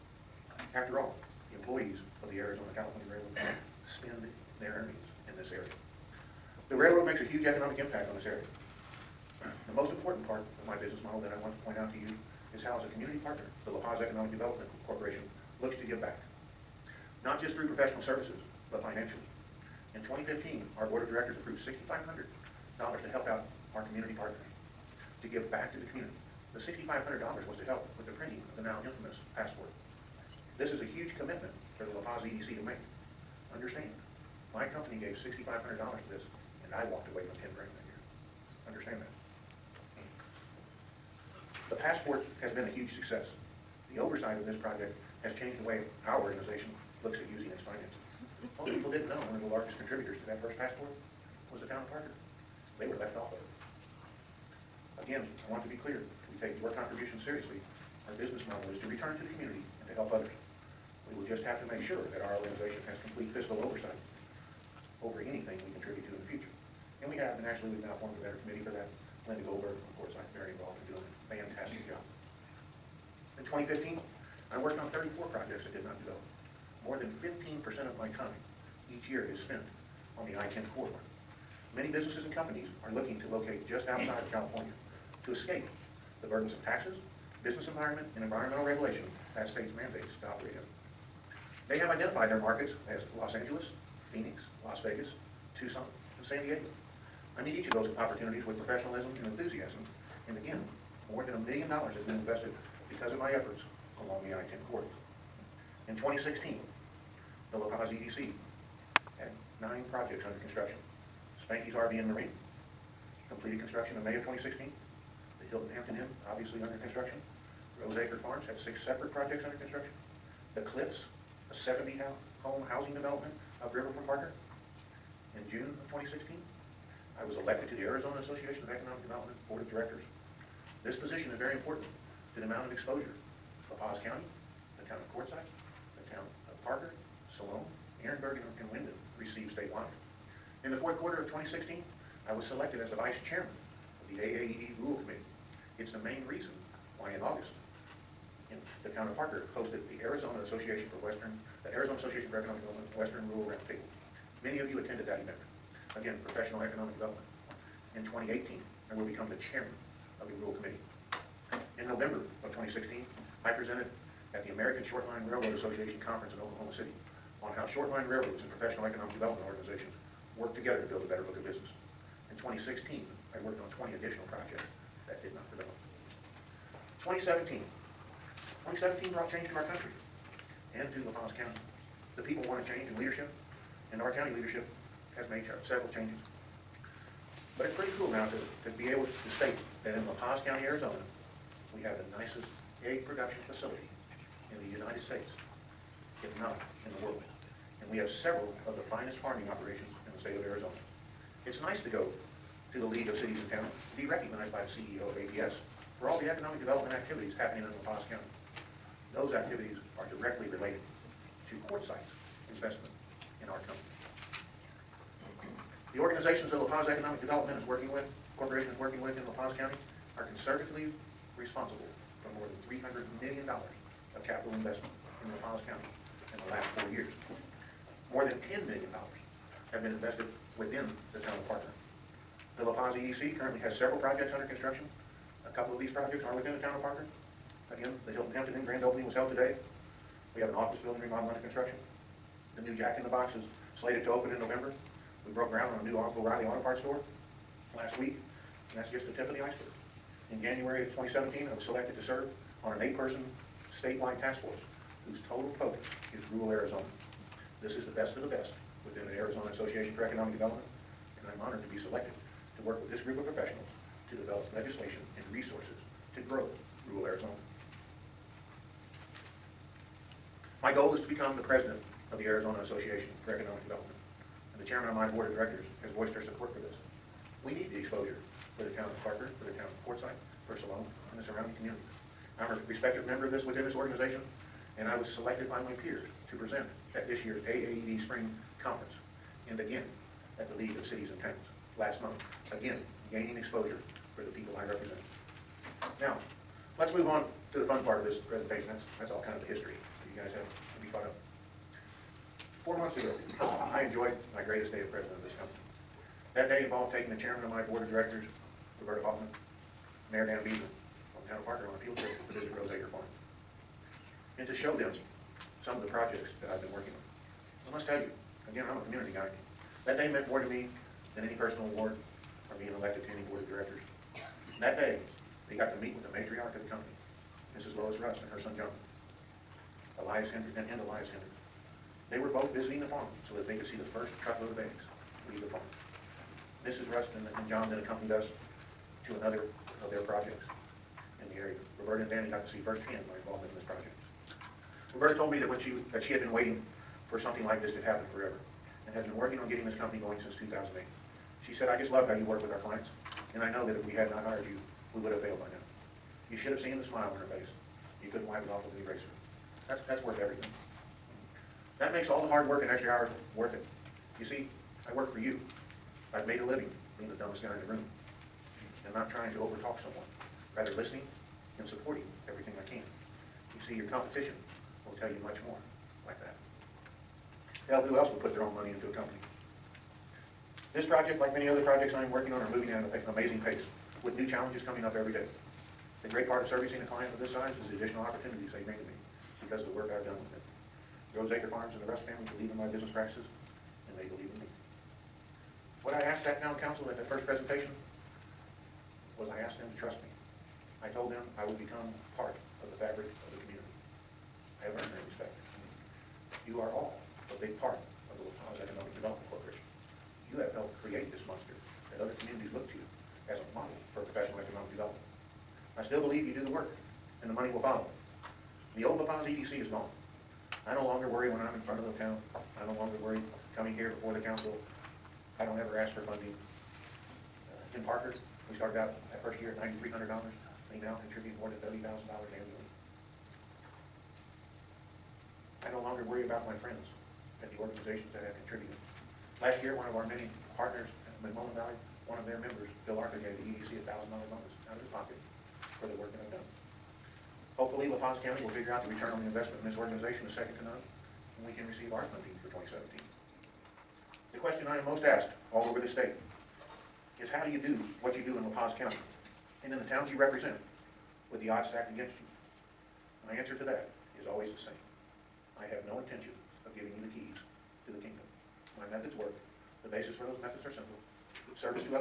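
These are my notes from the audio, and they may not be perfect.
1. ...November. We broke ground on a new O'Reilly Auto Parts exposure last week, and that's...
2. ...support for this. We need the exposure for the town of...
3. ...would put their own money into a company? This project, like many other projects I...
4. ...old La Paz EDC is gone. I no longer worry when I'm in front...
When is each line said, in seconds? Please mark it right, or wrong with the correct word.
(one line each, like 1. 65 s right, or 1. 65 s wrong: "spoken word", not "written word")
1. 244 s wrong: "store", not "exposure"
2. 276 s right
3. 378 s right
4. 418 s right.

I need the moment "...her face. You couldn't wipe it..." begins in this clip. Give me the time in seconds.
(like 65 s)
357 s.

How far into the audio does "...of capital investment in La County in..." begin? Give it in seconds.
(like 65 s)
223 s.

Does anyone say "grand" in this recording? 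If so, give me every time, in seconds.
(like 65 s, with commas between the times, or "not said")
37 s, 238 s.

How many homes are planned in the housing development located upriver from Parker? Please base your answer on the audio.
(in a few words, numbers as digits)
70.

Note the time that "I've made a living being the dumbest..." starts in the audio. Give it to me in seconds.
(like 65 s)
366 s.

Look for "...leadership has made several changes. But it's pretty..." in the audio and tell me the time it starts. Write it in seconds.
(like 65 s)
184 s.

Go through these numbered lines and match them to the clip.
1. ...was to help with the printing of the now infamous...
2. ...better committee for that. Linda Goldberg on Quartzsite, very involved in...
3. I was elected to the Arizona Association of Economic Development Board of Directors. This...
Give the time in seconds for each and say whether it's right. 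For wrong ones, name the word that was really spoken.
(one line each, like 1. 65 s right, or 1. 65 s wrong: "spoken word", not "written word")
1. 27 s right
2. 68 s right
3. 127 s right.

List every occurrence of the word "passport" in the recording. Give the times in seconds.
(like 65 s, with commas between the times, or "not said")
29 s, 41 s, 50 s.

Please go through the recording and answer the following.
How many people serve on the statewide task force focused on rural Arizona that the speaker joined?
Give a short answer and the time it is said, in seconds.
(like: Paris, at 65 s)
8, at 252 s.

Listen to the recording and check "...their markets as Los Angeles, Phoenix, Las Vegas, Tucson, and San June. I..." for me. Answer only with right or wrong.
wrong.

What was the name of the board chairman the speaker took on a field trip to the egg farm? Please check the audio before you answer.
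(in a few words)
Roberta Hoffman.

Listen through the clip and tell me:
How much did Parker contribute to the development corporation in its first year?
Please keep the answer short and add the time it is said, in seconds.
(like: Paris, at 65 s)
$9,300, at 429 s.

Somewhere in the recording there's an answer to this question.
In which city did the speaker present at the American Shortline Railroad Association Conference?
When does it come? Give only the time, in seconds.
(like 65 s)
166 s.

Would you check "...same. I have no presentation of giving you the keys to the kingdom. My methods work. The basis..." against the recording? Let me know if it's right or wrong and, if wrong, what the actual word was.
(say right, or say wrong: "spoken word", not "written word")
wrong: "intention", not "presentation".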